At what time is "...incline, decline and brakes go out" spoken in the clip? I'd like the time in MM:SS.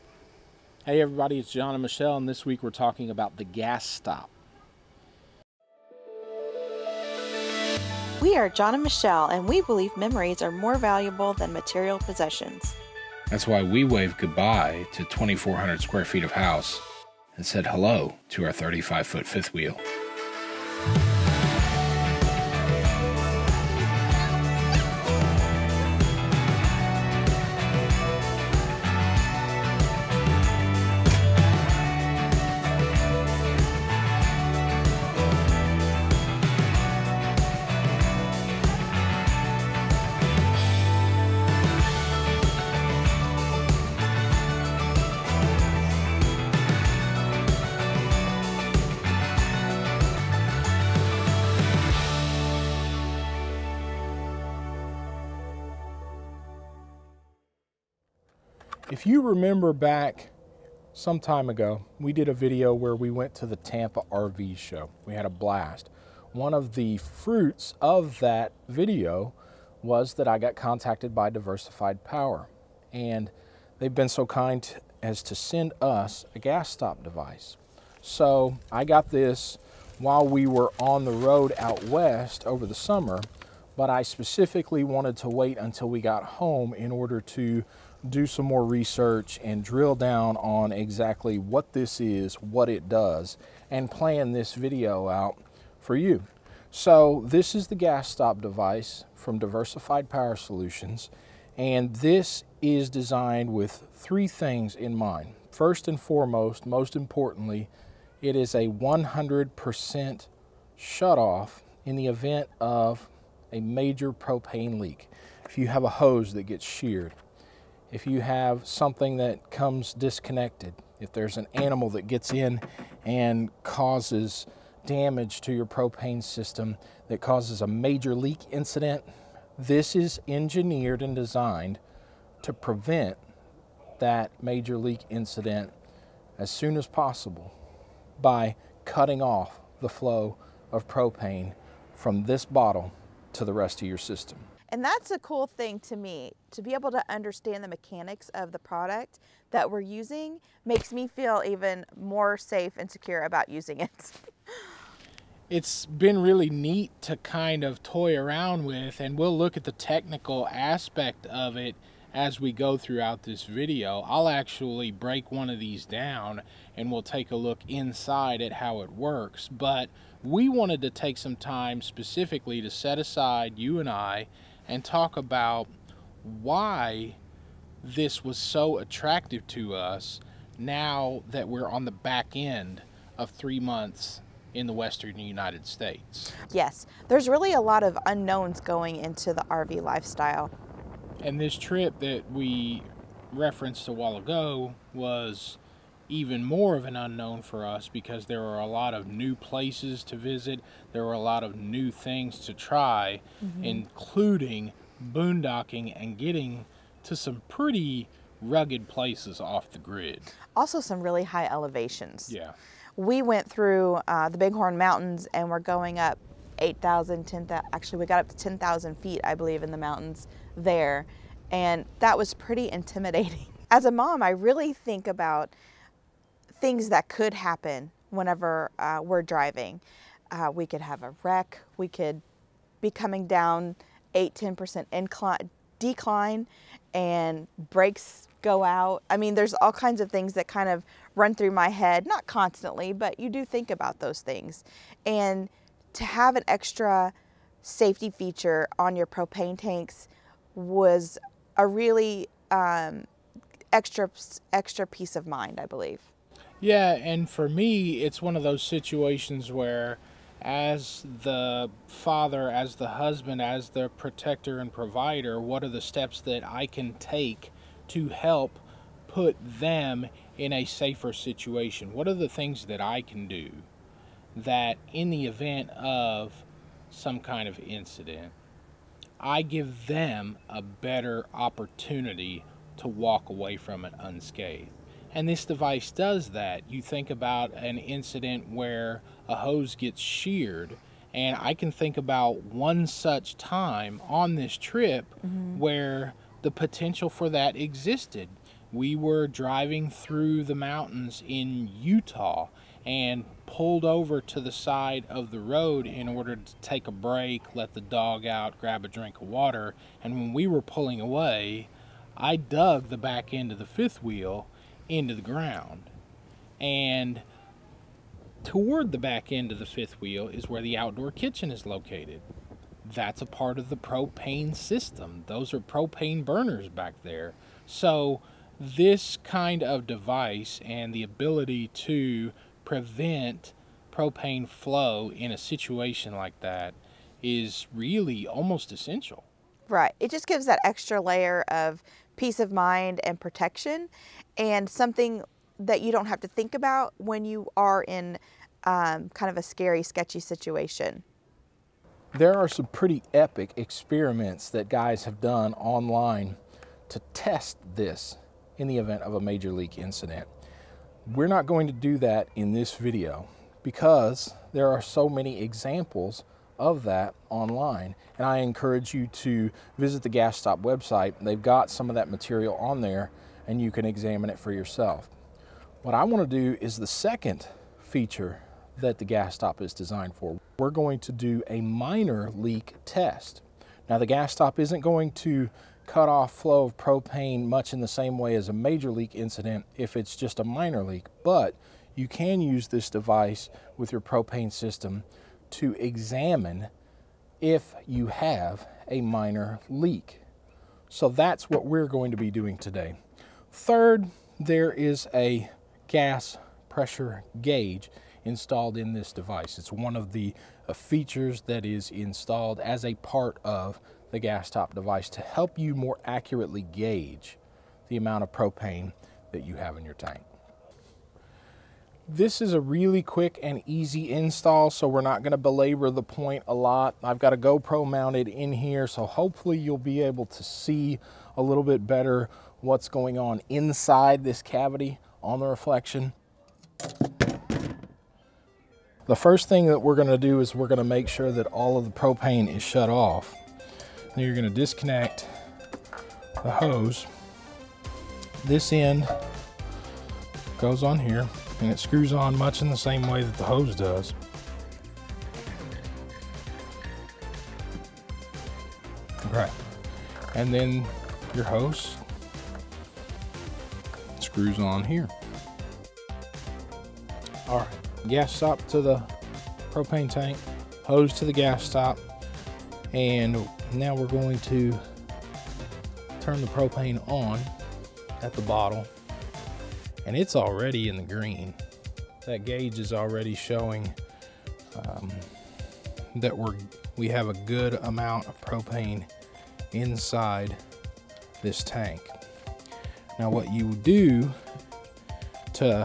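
03:54.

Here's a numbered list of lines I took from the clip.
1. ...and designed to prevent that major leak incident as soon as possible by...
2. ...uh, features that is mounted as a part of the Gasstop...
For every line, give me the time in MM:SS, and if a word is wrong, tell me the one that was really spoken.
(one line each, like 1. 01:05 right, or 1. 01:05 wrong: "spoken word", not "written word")
1. 02:11 right
2. 06:50 wrong: "installed", not "mounted".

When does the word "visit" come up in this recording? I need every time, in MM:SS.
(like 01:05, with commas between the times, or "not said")
03:20, 06:09.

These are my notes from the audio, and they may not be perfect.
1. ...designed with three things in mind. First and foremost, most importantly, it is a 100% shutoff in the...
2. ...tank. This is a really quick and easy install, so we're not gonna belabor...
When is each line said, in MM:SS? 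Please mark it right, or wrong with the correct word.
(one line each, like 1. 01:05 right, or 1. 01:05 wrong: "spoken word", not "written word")
1. 01:42 right
2. 06:59 right.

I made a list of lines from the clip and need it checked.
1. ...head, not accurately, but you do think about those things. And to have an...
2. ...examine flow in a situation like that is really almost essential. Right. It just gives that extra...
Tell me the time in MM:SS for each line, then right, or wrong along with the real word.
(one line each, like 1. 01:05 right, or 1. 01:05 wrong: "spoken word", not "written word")
1. 04:01 wrong: "constantly", not "accurately"
2. 05:33 wrong: "propane", not "examine".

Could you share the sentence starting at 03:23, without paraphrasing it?
including boondocking and getting to some pretty rugged places off the grid.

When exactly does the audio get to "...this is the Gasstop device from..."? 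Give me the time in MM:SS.
01:37.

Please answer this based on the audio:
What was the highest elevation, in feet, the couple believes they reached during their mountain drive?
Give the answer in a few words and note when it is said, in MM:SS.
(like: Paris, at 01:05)
10,000 feet, at 03:38.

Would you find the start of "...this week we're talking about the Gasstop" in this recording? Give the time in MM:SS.
00:02.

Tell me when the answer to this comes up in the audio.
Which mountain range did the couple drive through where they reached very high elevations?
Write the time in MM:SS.
03:34.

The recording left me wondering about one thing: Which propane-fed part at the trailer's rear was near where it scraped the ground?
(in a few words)
outdoor kitchen.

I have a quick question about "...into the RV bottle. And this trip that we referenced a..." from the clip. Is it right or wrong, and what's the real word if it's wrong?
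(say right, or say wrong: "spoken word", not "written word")
wrong: "lifestyle", not "bottle".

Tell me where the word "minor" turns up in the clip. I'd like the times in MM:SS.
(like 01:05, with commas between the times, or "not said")
06:21, 06:30, 06:39.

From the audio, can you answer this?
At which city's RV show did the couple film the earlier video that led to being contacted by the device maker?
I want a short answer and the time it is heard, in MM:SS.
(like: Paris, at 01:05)
Tampa, at 01:03.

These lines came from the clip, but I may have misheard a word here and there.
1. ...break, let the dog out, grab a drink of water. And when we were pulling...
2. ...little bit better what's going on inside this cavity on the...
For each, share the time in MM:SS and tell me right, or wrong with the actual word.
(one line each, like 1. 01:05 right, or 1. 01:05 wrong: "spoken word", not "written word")
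1. 05:06 right
2. 07:11 right.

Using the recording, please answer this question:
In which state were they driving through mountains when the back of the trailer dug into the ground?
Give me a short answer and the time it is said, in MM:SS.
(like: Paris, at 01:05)
Utah, at 05:01.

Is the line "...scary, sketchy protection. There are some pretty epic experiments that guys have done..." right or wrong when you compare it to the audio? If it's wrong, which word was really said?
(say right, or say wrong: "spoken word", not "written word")
wrong: "situation", not "protection".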